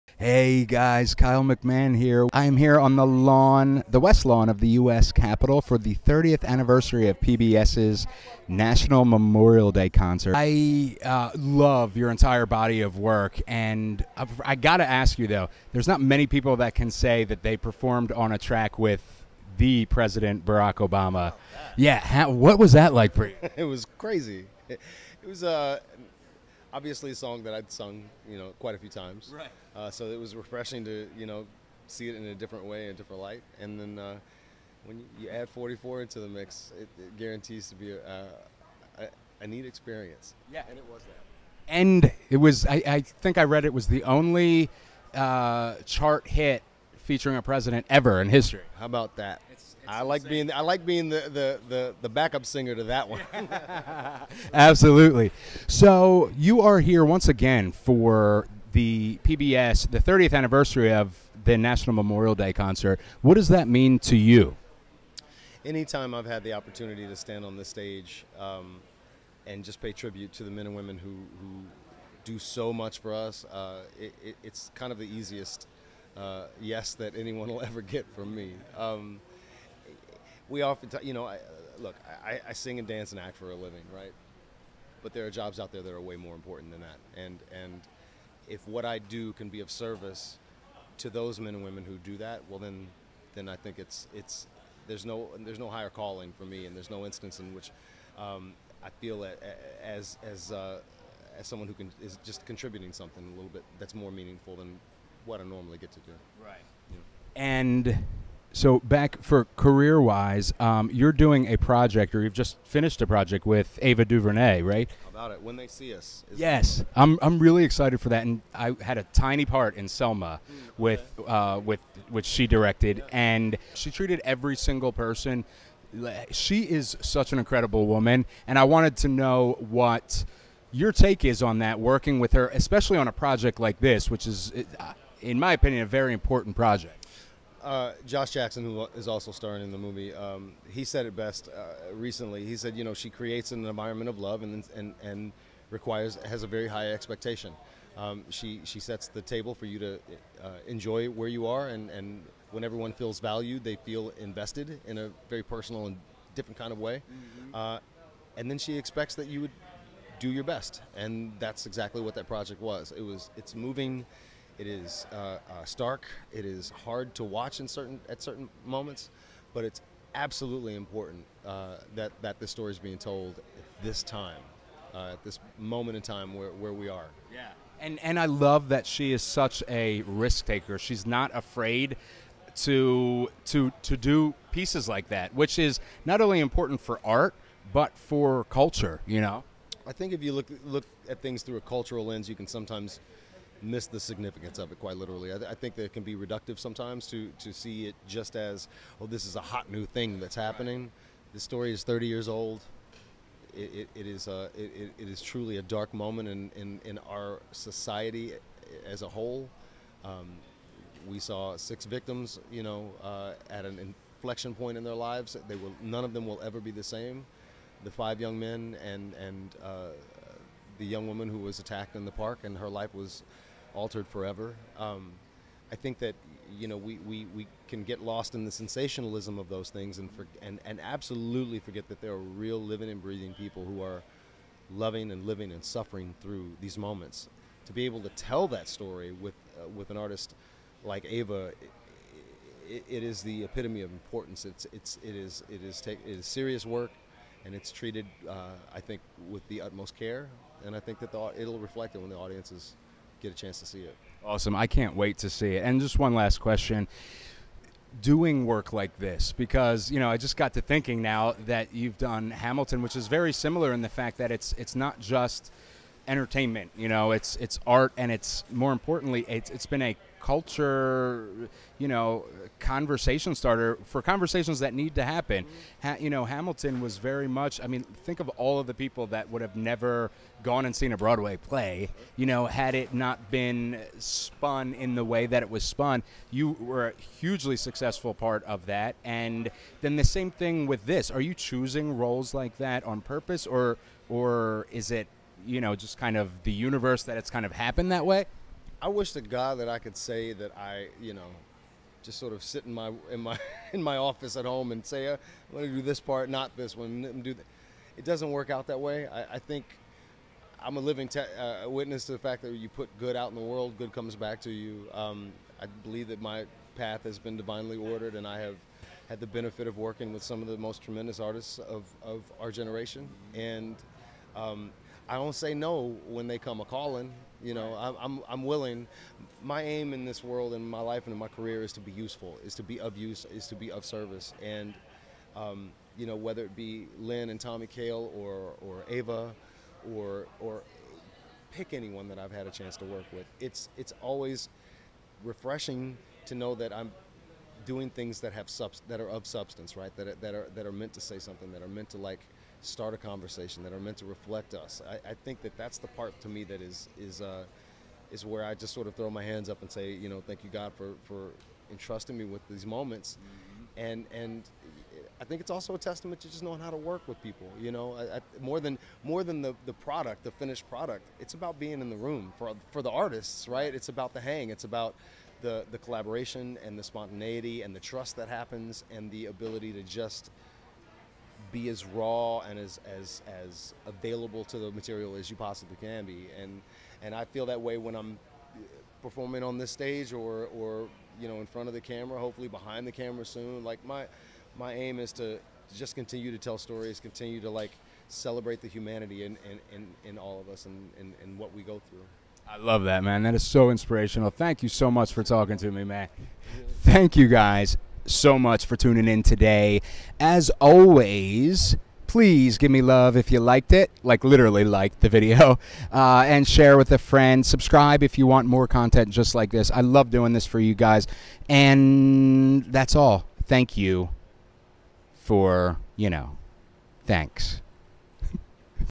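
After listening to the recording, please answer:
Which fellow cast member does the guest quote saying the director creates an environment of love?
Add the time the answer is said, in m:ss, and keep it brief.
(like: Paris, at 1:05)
Josh Jackson, at 2:18.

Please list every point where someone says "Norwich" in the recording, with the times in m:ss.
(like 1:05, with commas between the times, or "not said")
not said.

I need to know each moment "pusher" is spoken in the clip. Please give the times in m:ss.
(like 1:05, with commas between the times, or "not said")
not said.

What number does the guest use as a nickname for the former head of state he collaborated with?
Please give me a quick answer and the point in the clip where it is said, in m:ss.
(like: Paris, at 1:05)
44, at 0:35.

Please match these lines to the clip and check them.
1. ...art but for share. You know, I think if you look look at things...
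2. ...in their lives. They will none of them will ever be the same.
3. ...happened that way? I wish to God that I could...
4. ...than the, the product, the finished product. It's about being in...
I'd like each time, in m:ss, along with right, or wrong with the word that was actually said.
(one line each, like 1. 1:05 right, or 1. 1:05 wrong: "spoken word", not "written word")
1. 3:07 wrong: "culture", not "share"
2. 3:34 right
3. 4:57 right
4. 6:09 right.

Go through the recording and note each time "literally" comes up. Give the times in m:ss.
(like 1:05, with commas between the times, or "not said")
3:14, 6:54.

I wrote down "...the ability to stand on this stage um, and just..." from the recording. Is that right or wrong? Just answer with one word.
wrong.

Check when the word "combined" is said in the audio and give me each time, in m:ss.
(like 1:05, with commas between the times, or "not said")
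not said.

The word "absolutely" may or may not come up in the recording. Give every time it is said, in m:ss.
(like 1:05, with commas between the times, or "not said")
0:54, 2:50, 3:50.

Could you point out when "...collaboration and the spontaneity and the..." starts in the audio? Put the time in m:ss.
6:15.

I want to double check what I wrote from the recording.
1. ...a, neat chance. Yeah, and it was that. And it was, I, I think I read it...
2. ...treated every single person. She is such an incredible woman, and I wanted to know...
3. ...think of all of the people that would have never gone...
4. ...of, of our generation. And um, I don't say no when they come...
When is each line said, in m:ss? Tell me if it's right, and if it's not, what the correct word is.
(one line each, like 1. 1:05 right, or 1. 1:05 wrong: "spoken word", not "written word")
1. 0:39 wrong: "experience", not "chance"
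2. 2:03 right
3. 4:38 right
4. 5:21 right.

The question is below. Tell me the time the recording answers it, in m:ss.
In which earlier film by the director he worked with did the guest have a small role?
1:59.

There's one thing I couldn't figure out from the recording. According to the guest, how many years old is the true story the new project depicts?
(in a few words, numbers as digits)
30.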